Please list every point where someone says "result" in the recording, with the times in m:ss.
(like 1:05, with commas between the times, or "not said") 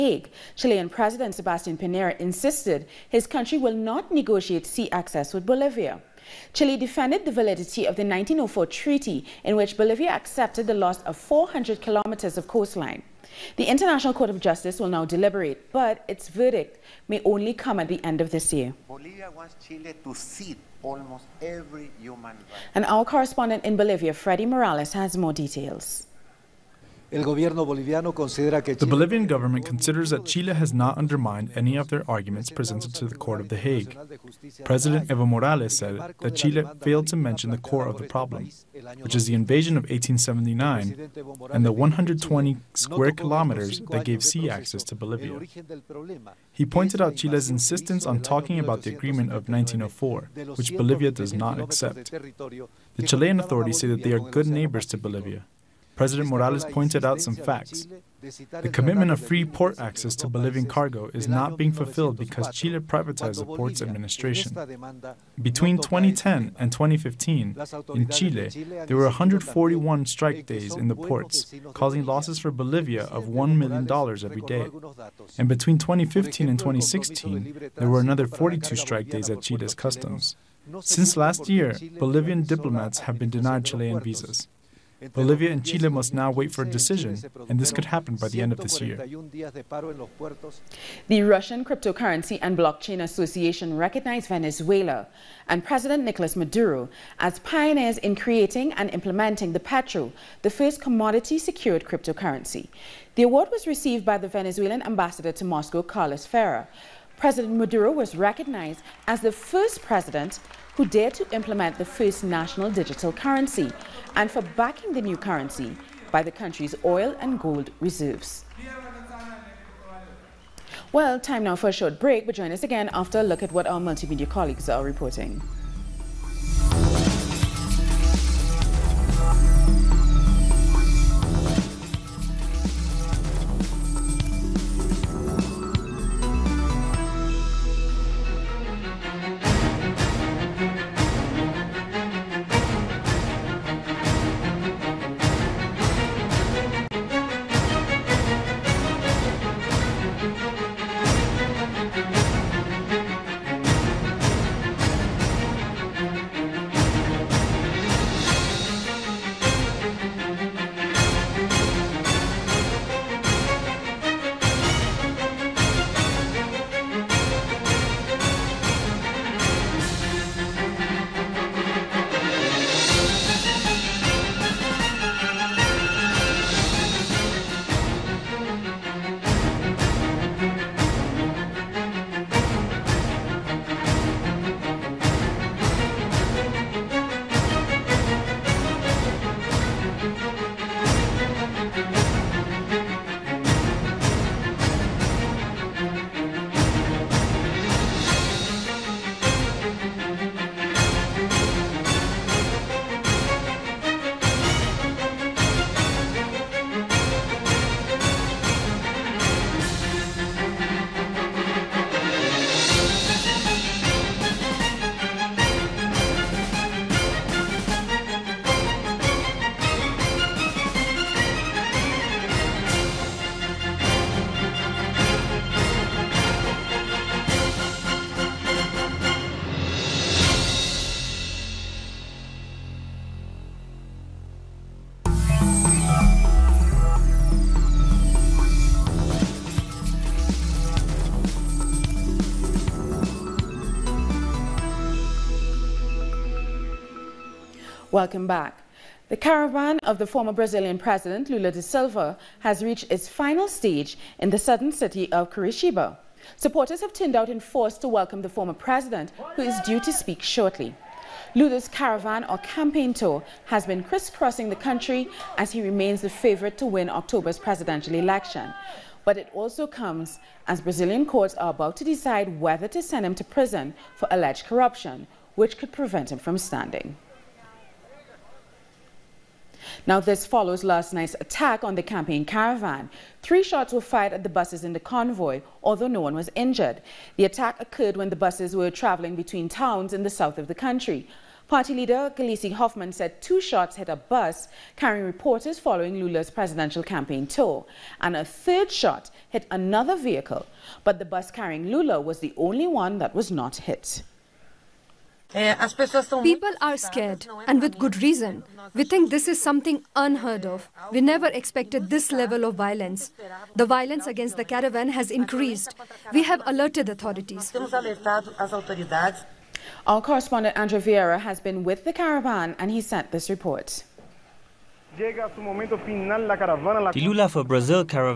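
not said.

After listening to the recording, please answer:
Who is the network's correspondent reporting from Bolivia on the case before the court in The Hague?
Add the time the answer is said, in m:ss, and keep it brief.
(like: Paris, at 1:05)
Freddy Morales, at 0:24.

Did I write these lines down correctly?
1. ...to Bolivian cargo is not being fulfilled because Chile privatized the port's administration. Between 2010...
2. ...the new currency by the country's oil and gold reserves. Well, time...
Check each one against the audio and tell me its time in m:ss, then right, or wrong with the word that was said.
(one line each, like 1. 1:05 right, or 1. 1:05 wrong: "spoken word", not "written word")
1. 1:00 right
2. 1:54 right.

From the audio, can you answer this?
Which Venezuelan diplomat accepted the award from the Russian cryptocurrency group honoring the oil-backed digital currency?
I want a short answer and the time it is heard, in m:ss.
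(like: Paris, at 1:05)
Carlos Ferrer, at 1:45.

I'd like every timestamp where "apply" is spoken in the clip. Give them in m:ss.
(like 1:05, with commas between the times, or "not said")
not said.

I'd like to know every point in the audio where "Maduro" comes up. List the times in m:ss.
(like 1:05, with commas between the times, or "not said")
1:36, 1:47.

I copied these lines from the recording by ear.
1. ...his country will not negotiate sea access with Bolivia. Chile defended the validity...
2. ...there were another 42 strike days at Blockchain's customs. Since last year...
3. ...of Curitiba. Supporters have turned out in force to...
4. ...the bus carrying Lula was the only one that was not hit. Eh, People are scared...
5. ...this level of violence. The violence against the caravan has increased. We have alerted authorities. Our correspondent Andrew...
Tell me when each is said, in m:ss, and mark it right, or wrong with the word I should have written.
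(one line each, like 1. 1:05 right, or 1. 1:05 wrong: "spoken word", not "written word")
1. 0:03 right
2. 1:17 wrong: "Chile", not "Blockchain"
3. 4:15 right
4. 5:00 right
5. 5:11 right.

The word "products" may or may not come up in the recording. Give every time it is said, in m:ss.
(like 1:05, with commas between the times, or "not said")
not said.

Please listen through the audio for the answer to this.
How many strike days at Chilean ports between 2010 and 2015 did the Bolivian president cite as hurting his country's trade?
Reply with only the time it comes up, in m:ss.
1:09.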